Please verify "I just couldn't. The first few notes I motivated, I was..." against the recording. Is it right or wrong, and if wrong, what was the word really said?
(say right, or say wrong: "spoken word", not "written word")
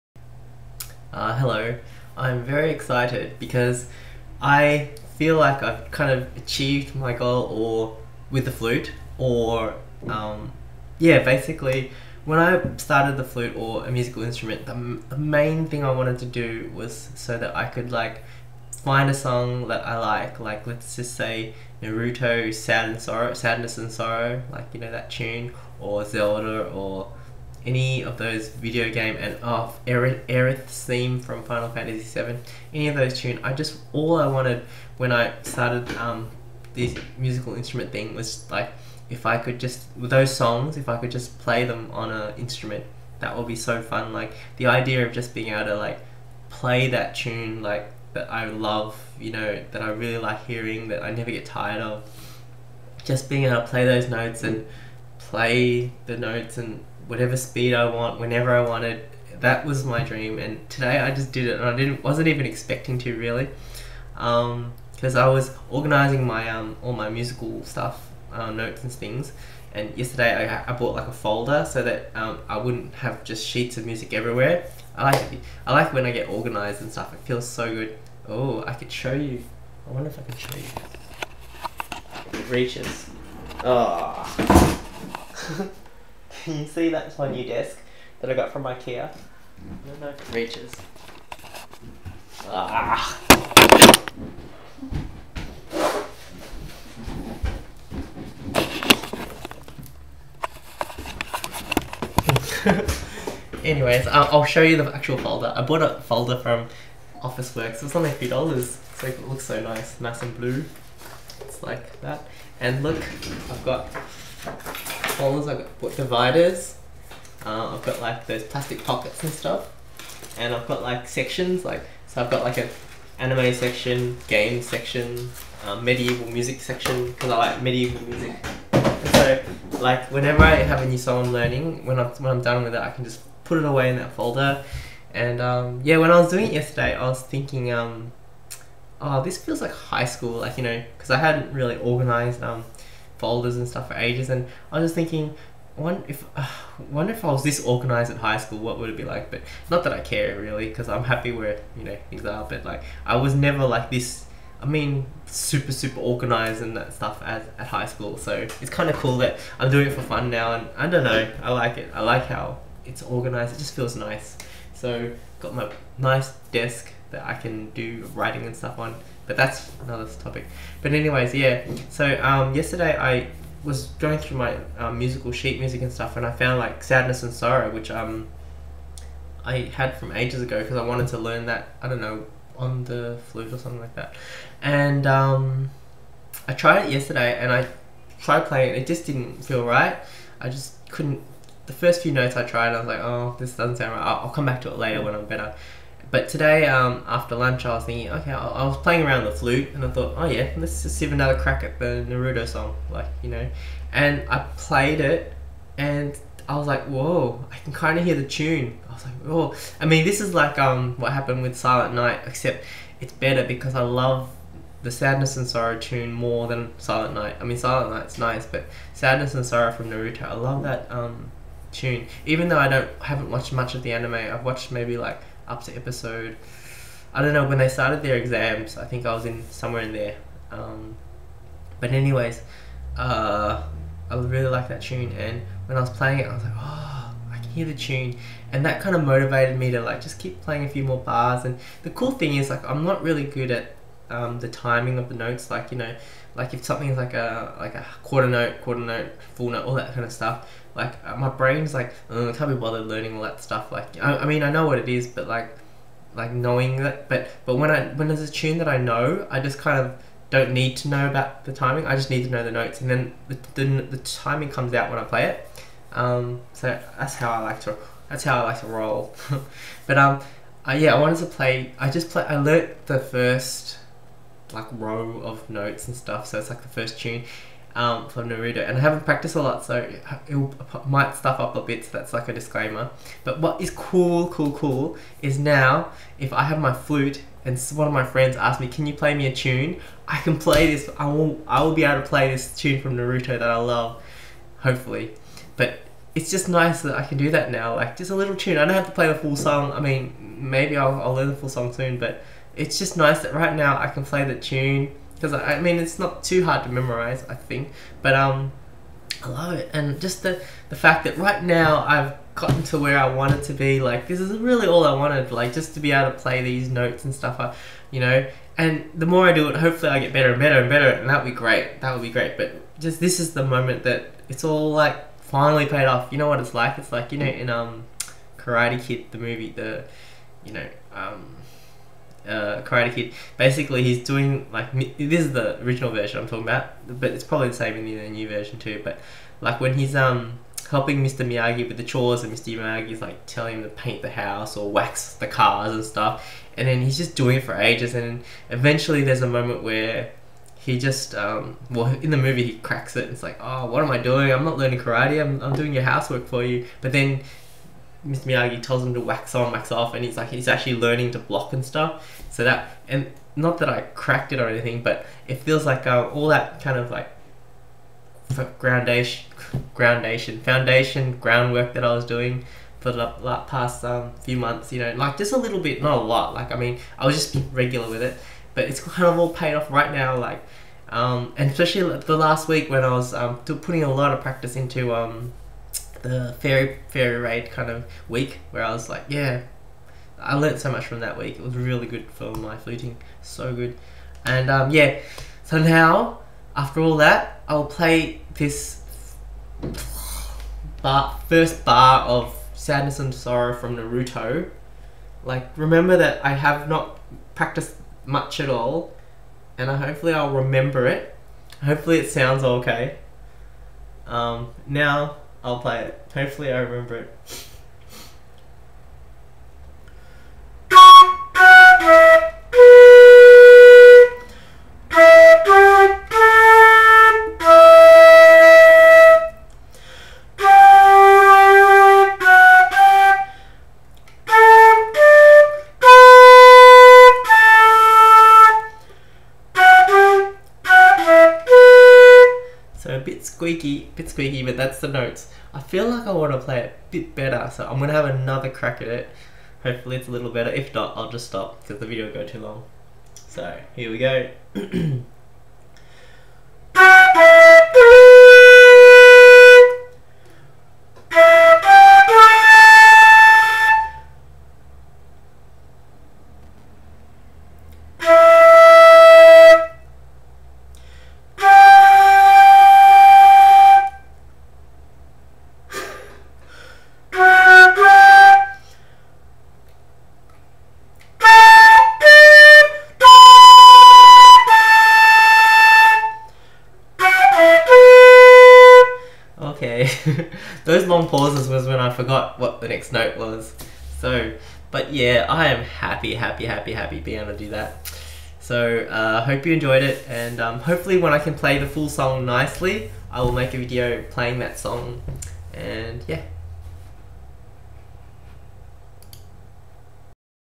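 wrong: "tried", not "motivated".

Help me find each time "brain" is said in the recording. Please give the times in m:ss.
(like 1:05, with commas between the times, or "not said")
4:11.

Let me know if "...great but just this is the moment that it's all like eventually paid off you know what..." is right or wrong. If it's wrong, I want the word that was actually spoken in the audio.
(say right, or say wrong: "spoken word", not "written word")
wrong: "finally", not "eventually".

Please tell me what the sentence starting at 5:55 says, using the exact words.
I'm I'm doing your housework for you.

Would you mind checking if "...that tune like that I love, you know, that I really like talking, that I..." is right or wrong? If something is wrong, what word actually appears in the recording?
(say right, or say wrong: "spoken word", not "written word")
wrong: "hearing", not "talking".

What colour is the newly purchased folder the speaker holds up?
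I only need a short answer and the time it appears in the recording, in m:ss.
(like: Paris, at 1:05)
Blue, at 1:50.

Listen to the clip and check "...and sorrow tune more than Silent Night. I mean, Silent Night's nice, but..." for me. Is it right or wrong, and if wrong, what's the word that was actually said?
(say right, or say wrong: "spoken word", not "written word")
right.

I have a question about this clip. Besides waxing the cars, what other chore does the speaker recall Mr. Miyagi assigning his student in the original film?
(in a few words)
Paint the house.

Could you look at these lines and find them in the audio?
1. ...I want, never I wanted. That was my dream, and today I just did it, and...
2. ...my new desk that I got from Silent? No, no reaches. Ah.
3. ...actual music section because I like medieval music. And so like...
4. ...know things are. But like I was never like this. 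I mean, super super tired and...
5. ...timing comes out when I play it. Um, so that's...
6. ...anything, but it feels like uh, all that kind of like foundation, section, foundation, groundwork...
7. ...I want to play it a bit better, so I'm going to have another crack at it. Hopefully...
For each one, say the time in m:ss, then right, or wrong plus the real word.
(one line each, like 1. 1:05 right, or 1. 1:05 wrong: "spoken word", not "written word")
1. 0:57 wrong: "whenever", not "never"
2. 1:27 wrong: "IKEA", not "Silent"
3. 2:05 wrong: "medieval", not "actual"
4. 2:31 wrong: "organized", not "tired"
5. 4:23 right
6. 6:04 wrong: "groundation", not "section"
7. 7:26 right.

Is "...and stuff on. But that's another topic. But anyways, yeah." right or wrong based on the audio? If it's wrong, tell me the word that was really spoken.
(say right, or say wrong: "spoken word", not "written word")
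right.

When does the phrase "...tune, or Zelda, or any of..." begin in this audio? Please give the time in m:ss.
0:25.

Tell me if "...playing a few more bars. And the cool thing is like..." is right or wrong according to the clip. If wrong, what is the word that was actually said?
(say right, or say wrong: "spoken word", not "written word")
right.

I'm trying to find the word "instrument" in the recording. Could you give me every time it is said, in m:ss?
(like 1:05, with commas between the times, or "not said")
0:14, 0:37, 0:42.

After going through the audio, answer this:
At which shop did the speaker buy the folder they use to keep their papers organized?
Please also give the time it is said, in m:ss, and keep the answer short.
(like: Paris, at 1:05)
Officeworks, at 1:47.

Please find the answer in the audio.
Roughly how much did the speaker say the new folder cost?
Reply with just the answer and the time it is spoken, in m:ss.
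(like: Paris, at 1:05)
A few dollars, at 1:48.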